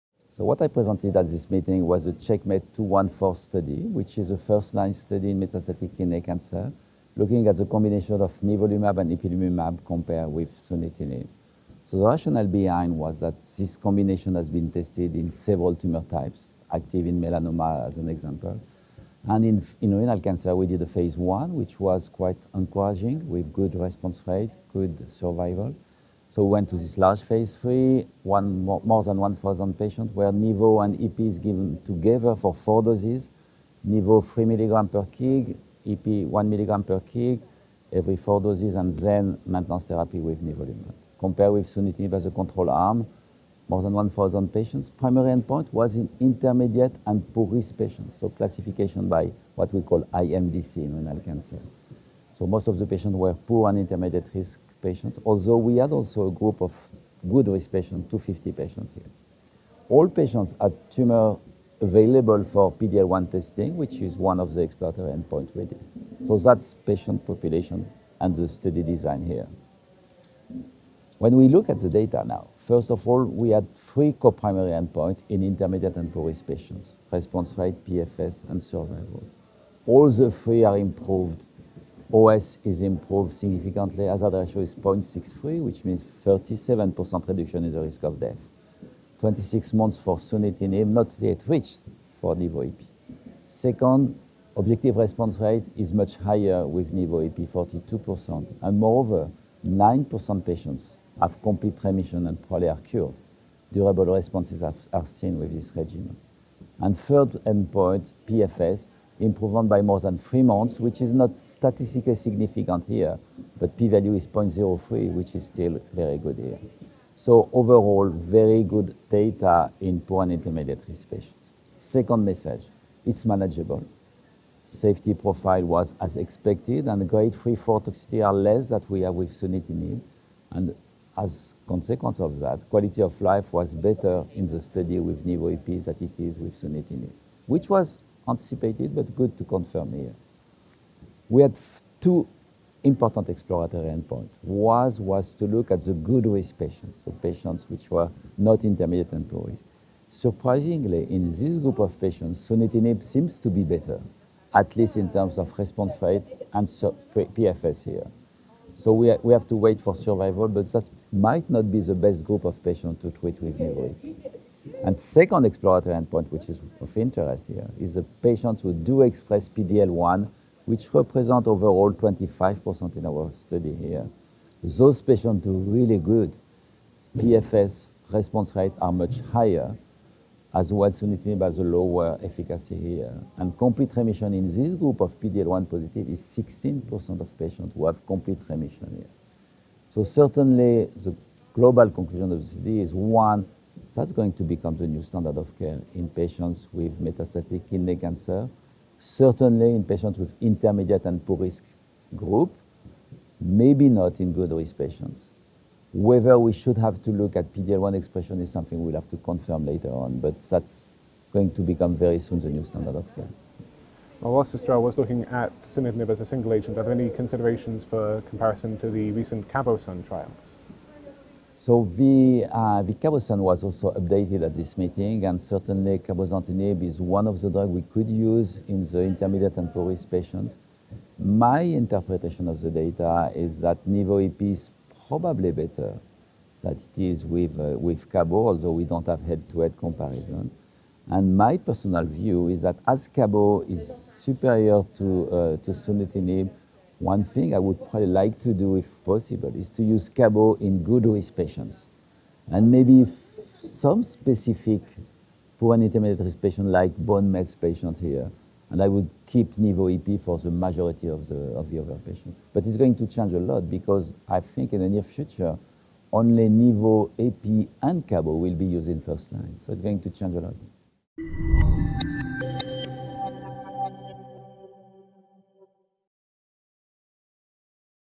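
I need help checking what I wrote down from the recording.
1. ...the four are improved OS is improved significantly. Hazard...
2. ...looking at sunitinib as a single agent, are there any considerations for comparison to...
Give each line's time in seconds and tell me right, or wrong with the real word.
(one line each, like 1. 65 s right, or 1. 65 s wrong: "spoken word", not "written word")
1. 80 s wrong: "three", not "four"
2. 214 s right.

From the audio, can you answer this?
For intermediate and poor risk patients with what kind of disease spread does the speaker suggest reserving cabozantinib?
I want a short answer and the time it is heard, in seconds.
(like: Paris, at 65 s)
bone mets, at 256 s.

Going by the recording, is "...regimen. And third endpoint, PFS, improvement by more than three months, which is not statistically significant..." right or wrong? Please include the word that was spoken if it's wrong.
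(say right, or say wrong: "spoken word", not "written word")
right.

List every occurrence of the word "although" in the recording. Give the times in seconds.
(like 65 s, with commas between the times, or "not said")
55 s, 238 s.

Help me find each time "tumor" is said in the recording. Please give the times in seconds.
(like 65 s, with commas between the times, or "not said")
15 s, 60 s.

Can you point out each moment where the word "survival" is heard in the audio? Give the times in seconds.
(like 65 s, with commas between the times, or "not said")
25 s, 78 s, 159 s.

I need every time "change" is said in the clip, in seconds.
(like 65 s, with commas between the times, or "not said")
263 s, 270 s.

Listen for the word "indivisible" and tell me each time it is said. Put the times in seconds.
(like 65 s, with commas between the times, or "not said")
not said.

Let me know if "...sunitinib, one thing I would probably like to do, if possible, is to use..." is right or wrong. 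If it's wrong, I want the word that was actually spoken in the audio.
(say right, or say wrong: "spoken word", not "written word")
right.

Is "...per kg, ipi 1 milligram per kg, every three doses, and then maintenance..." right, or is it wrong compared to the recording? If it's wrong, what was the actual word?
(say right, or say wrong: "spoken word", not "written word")
wrong: "four", not "three".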